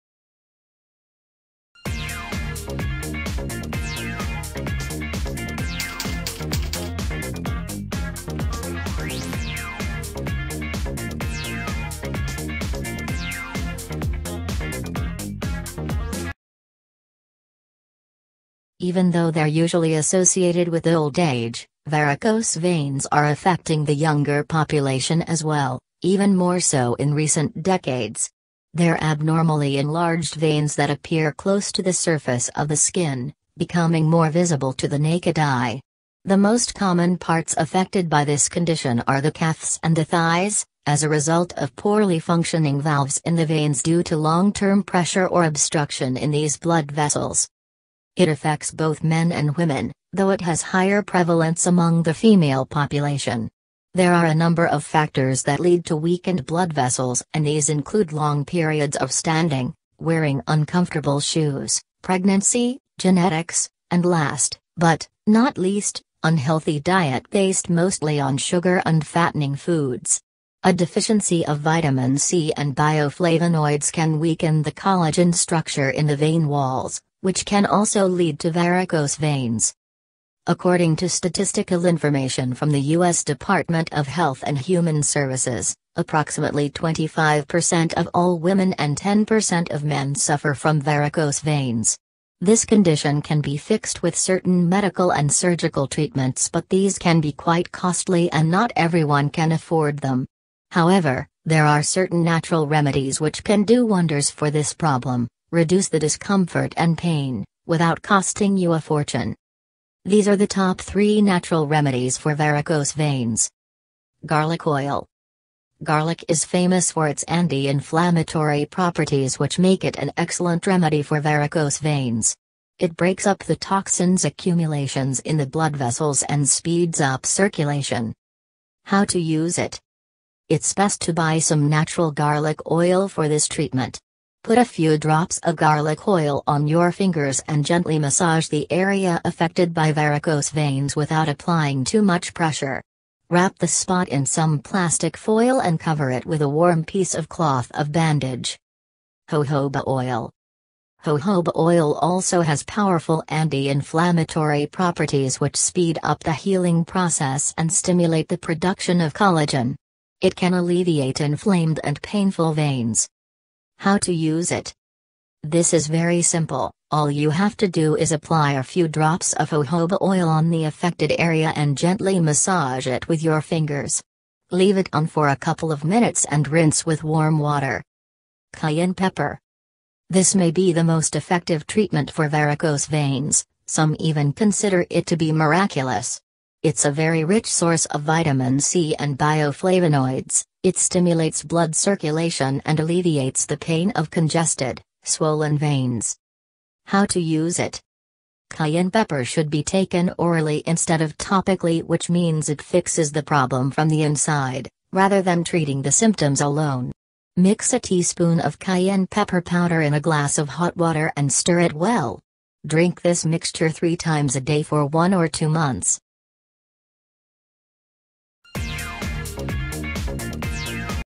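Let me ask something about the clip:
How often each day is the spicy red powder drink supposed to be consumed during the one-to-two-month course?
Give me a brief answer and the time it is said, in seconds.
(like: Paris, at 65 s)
3 times a day, at 213 s.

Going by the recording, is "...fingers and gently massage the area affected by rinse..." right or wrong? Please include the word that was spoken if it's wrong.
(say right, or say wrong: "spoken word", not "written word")
wrong: "varicose", not "rinse".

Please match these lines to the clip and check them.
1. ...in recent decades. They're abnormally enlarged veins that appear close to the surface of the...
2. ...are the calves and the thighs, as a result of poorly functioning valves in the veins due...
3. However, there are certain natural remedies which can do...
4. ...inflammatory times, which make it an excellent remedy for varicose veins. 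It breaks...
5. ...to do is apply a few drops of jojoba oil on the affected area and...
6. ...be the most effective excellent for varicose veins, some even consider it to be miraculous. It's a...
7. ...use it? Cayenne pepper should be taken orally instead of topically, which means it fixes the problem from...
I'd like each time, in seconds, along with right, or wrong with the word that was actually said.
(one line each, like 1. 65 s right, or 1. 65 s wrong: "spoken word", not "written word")
1. 26 s right
2. 39 s right
3. 100 s right
4. 117 s wrong: "properties", not "times"
5. 167 s right
6. 180 s wrong: "treatment", not "excellent"
7. 197 s right.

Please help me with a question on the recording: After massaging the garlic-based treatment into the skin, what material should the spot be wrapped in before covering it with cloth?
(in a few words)
plastic foil.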